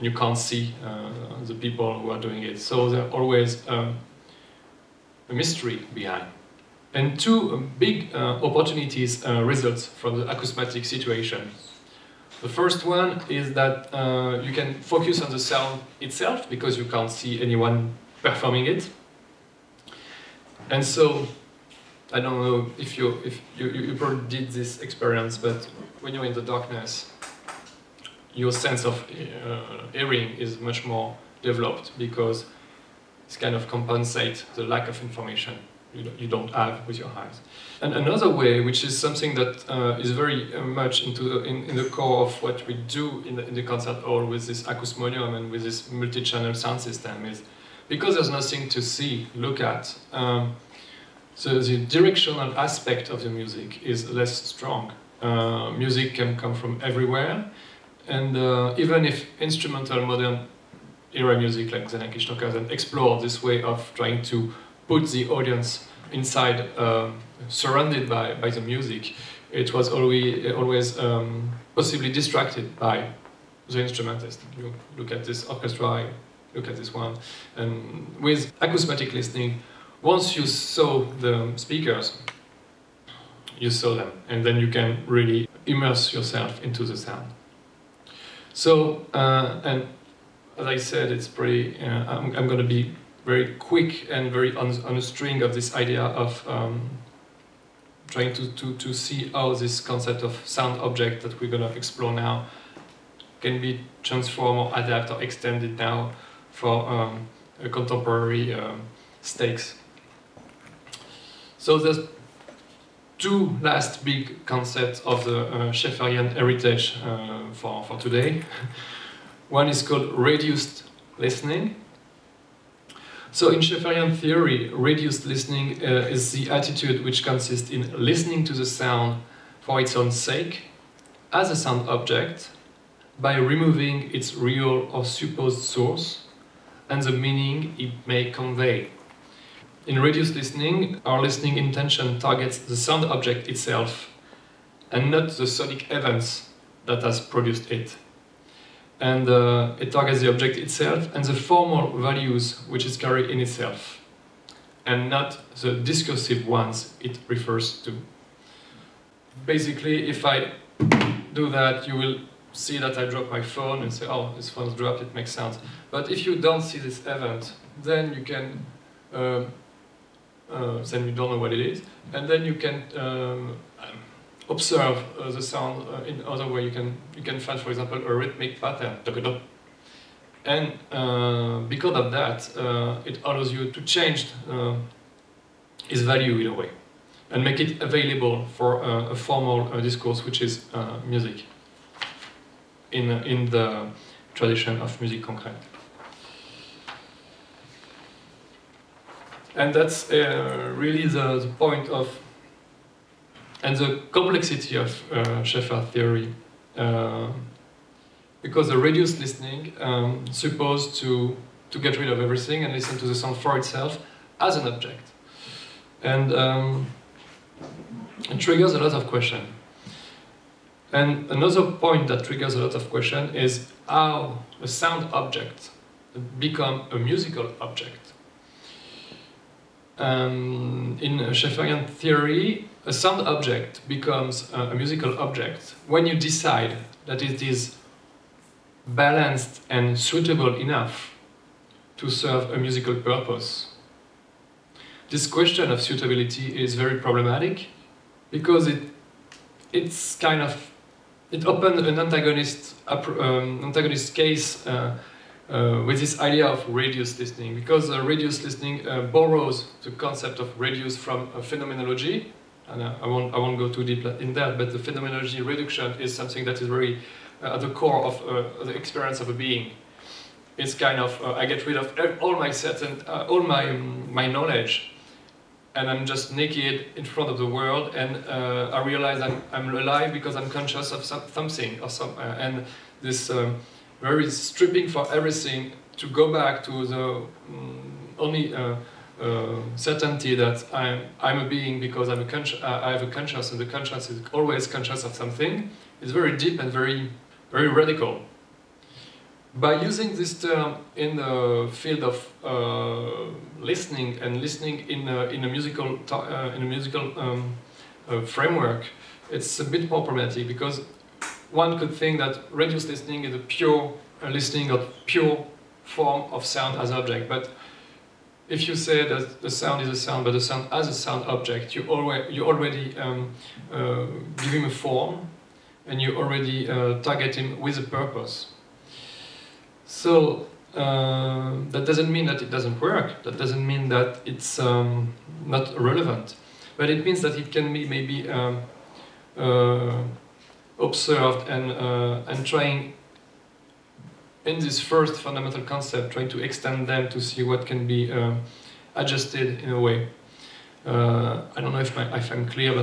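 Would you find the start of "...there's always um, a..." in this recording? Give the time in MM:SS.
00:02.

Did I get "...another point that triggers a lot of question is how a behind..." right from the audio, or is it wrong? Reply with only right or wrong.
wrong.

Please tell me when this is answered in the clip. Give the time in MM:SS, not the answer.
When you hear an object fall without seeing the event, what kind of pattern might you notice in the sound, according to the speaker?
02:58.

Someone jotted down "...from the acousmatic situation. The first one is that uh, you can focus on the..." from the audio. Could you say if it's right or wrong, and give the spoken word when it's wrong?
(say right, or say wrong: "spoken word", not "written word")
right.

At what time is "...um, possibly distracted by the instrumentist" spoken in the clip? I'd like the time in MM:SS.
01:10.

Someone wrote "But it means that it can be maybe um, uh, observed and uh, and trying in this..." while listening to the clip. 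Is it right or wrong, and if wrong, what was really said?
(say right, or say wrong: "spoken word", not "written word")
right.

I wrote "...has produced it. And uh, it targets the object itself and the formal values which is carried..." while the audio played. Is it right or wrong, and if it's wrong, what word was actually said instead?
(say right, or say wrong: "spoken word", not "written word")
right.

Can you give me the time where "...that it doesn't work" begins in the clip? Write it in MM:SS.
05:32.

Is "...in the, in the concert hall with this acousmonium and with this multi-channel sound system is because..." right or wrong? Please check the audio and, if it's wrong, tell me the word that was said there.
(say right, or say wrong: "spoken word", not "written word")
right.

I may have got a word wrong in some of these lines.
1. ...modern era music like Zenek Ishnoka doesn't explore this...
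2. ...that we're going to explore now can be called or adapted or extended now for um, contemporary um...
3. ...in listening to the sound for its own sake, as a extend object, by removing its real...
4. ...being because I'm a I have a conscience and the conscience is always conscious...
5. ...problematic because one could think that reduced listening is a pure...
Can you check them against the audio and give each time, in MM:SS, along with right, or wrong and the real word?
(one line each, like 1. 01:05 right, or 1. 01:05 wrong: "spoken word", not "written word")
1. 01:00 right
2. 01:41 wrong: "transformed", not "called"
3. 02:07 wrong: "sound", not "extend"
4. 04:51 right
5. 05:10 right.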